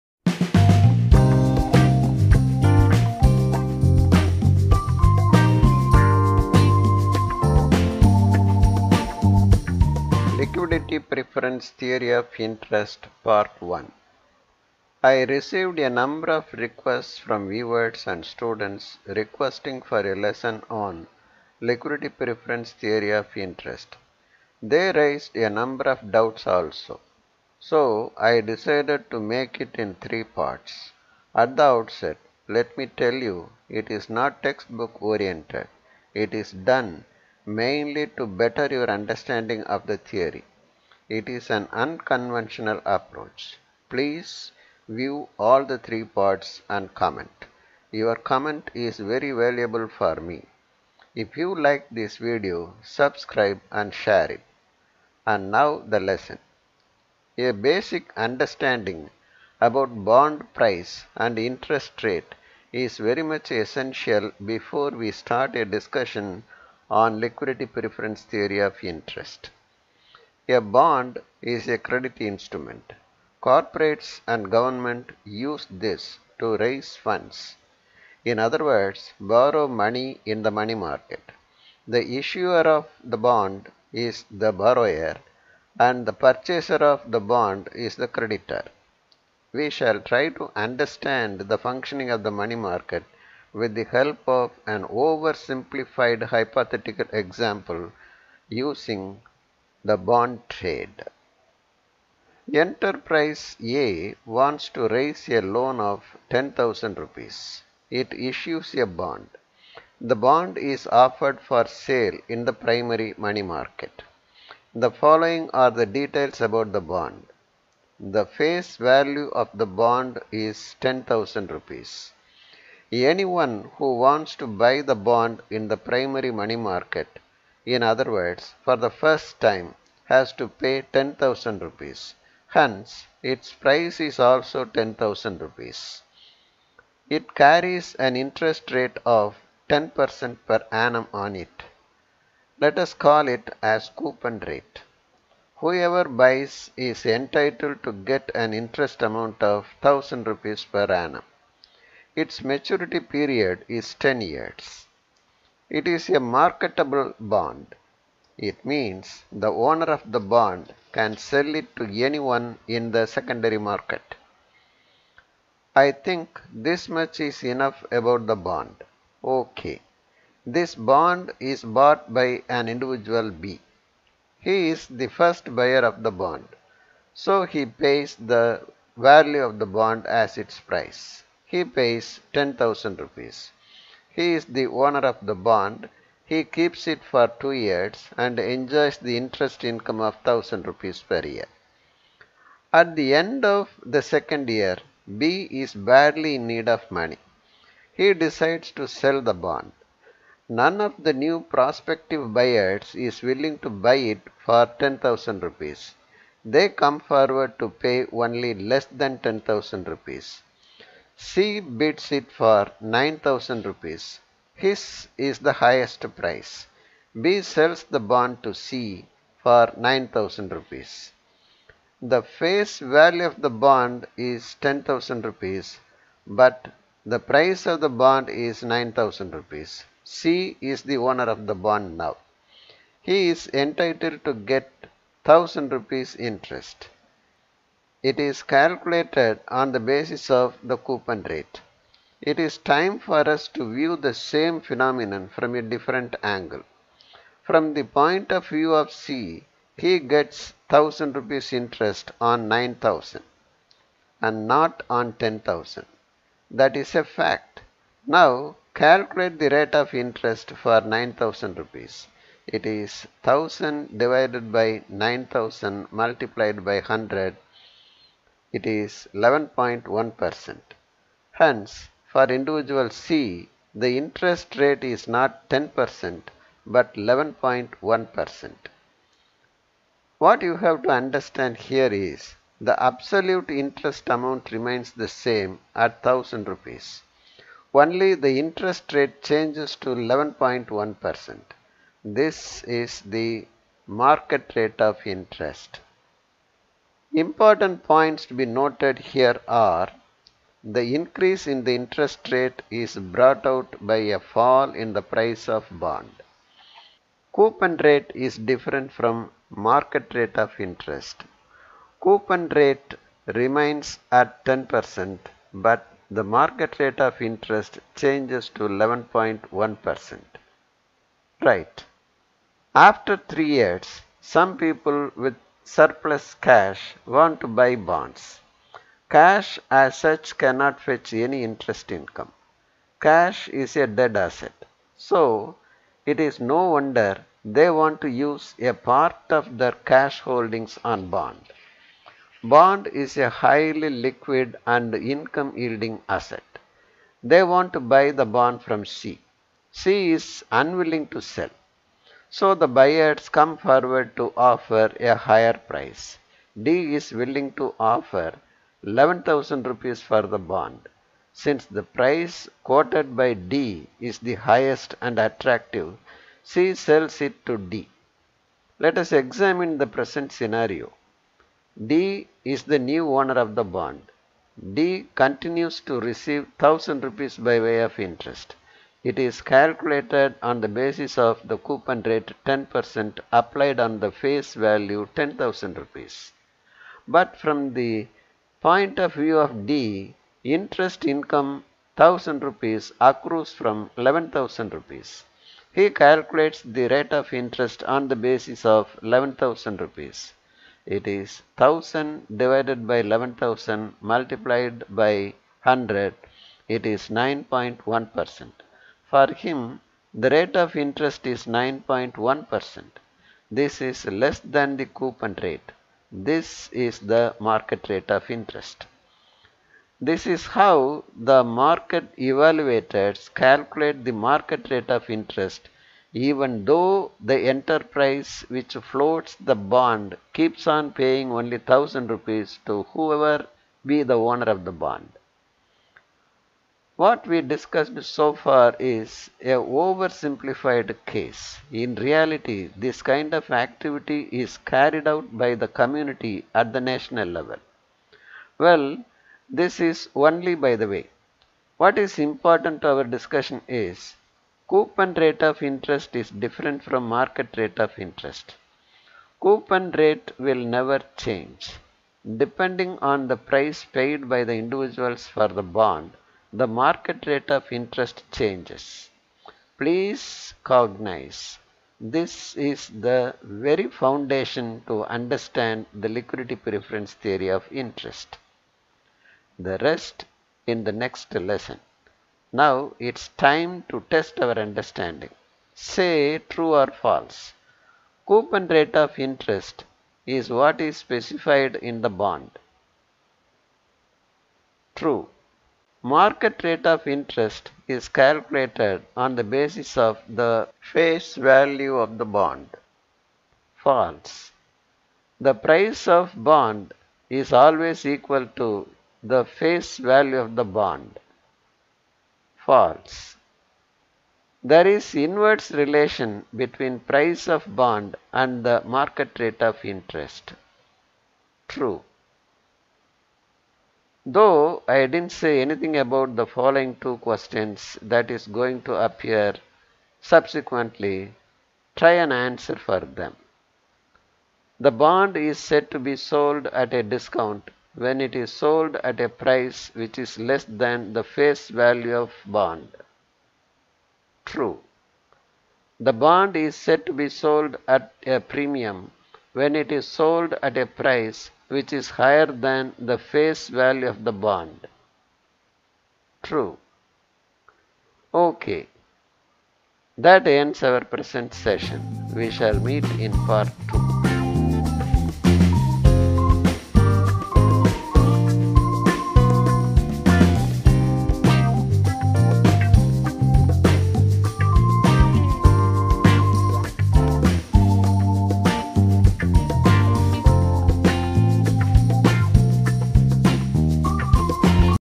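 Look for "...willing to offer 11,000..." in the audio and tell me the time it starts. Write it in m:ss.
5:57.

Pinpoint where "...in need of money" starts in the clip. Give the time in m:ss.
3:16.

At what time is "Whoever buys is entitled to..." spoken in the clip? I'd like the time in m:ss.
2:25.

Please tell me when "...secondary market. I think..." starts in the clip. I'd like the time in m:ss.
2:43.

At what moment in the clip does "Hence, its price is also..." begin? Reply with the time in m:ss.
2:12.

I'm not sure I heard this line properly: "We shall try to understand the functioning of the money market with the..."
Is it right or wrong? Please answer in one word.
right.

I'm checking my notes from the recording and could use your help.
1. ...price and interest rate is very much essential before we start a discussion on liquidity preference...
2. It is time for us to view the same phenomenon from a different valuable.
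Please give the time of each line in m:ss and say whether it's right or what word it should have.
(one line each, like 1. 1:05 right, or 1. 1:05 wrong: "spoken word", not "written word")
1. 1:00 right
2. 4:02 wrong: "angle", not "valuable".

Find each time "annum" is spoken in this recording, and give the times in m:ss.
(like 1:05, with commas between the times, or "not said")
2:20, 2:30.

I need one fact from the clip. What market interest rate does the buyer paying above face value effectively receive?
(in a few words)
9.1%.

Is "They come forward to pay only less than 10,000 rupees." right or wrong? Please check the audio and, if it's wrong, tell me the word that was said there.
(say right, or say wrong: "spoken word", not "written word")
right.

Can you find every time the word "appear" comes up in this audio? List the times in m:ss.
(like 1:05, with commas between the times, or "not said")
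8:48.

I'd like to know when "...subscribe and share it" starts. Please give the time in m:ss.
0:52.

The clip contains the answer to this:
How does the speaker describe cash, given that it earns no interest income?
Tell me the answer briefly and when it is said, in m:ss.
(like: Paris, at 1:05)
A dead asset, at 5:33.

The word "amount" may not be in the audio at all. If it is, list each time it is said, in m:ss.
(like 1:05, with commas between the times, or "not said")
2:29, 4:44.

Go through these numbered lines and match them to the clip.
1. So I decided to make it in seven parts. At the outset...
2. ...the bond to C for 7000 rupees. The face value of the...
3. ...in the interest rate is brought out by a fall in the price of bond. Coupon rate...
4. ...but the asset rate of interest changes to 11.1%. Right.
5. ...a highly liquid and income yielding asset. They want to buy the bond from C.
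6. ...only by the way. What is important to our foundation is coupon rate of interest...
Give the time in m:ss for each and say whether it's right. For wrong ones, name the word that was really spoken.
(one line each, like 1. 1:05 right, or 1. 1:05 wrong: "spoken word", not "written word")
1. 0:27 wrong: "three", not "seven"
2. 3:37 wrong: "9000", not "7000"
3. 5:01 right
4. 5:15 wrong: "market", not "asset"
5. 5:43 right
6. 7:30 wrong: "discussion", not "foundation".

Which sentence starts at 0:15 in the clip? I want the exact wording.
I received a number of requests from viewers and students requesting for a lesson on liquidity preference theory of interest.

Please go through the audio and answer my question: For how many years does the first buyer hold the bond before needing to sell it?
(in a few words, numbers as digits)
2 years.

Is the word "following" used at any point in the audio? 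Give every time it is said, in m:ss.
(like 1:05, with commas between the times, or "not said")
1:54, 8:46.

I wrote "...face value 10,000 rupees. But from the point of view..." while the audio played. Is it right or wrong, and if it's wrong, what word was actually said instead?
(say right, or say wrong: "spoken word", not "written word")
right.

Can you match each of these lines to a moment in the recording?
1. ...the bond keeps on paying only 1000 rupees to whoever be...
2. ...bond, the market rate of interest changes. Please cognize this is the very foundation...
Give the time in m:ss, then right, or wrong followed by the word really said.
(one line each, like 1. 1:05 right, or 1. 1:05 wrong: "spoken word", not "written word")
1. 7:09 right
2. 7:45 right.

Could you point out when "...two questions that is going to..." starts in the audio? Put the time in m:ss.
8:46.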